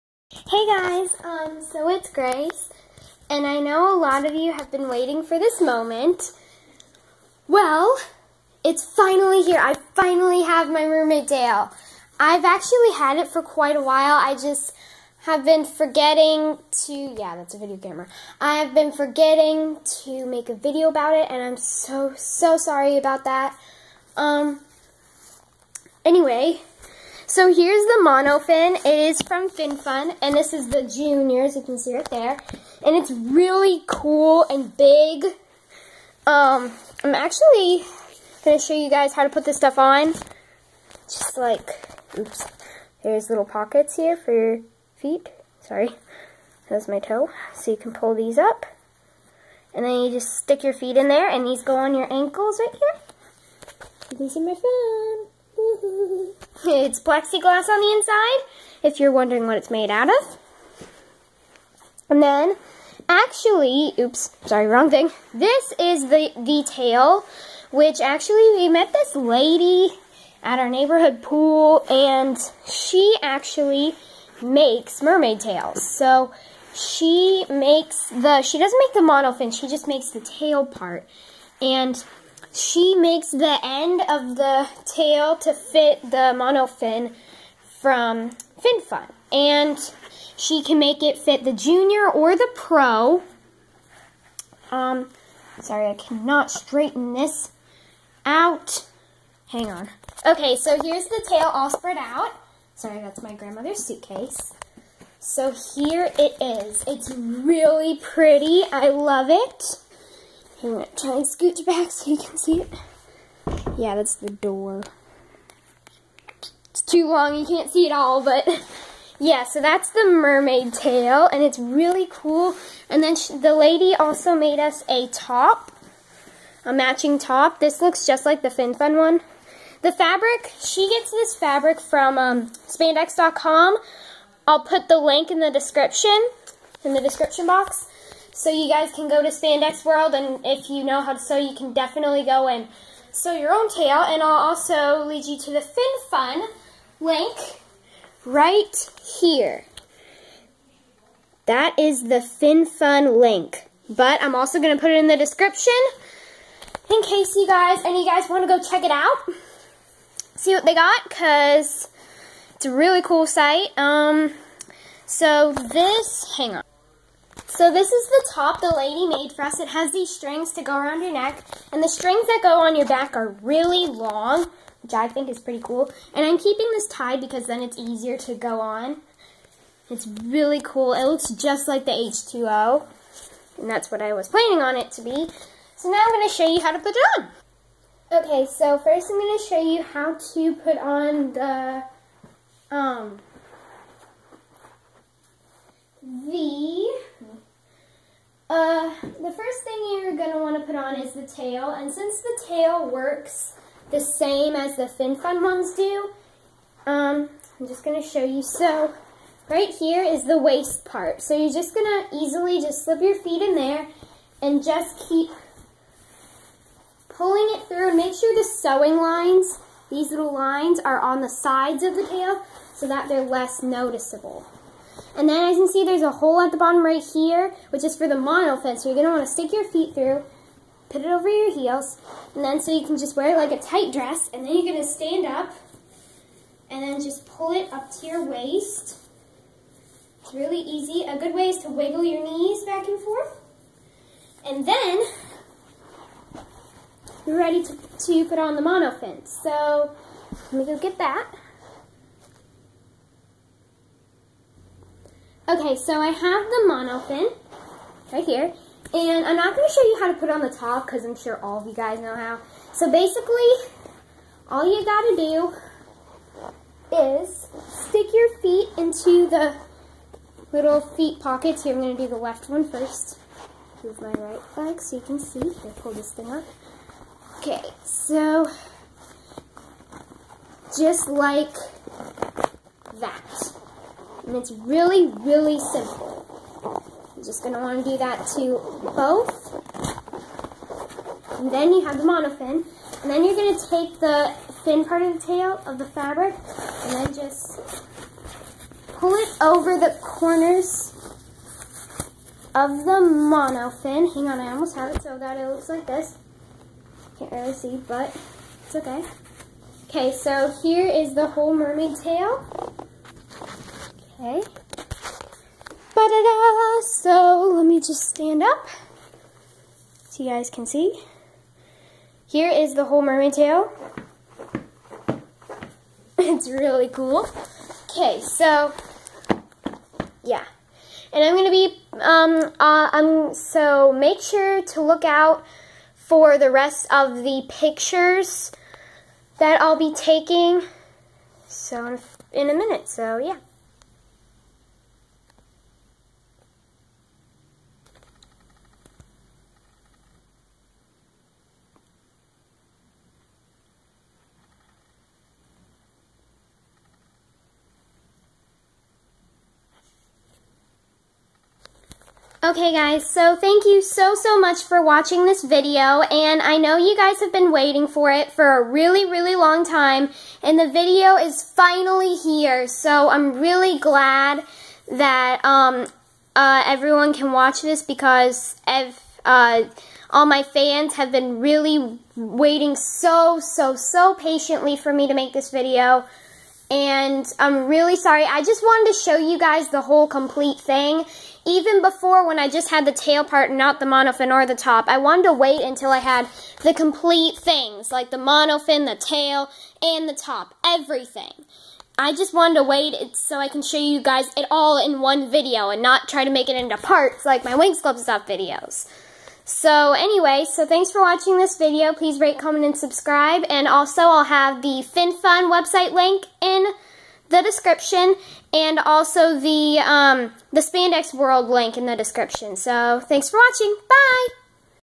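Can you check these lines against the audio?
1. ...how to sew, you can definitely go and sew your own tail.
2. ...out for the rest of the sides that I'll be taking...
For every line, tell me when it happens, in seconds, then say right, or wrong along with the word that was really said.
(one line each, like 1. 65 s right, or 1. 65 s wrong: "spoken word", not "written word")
1. 141 s right
2. 335 s wrong: "pictures", not "sides".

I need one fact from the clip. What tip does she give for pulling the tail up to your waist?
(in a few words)
Wiggle your knees.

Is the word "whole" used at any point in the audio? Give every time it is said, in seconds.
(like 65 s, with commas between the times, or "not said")
311 s, 322 s, 389 s.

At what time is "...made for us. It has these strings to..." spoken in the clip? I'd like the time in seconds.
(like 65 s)
169 s.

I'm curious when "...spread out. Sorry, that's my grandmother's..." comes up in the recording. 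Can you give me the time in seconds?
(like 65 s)
101 s.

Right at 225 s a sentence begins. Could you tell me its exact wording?
And then as you can see, there's a hole at the bottom right here, which is for the monofins.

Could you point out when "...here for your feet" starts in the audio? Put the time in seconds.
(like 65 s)
43 s.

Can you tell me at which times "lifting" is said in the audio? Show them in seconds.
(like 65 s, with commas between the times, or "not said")
not said.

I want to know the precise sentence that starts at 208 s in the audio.
So, right here is the waist part.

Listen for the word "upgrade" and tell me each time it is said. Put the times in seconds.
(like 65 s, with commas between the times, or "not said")
not said.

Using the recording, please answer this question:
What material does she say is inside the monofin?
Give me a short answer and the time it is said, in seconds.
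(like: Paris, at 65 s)
Plexiglass, at 56 s.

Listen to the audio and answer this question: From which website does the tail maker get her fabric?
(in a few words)
spandex.com.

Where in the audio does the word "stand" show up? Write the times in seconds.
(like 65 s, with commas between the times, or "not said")
234 s, 318 s.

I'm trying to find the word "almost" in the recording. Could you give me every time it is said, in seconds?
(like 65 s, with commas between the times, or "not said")
304 s.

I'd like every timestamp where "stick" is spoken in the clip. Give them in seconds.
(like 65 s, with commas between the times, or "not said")
50 s, 229 s, 267 s.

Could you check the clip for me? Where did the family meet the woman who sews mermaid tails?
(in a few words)
Neighborhood pool.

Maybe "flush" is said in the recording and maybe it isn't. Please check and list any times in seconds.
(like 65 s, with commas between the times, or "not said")
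not said.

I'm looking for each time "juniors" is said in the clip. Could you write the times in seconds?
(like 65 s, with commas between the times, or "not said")
30 s, 91 s.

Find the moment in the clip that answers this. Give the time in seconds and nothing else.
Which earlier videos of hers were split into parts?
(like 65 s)
407 s.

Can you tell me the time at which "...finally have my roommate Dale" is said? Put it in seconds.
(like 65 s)
9 s.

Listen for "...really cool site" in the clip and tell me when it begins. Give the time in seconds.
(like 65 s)
162 s.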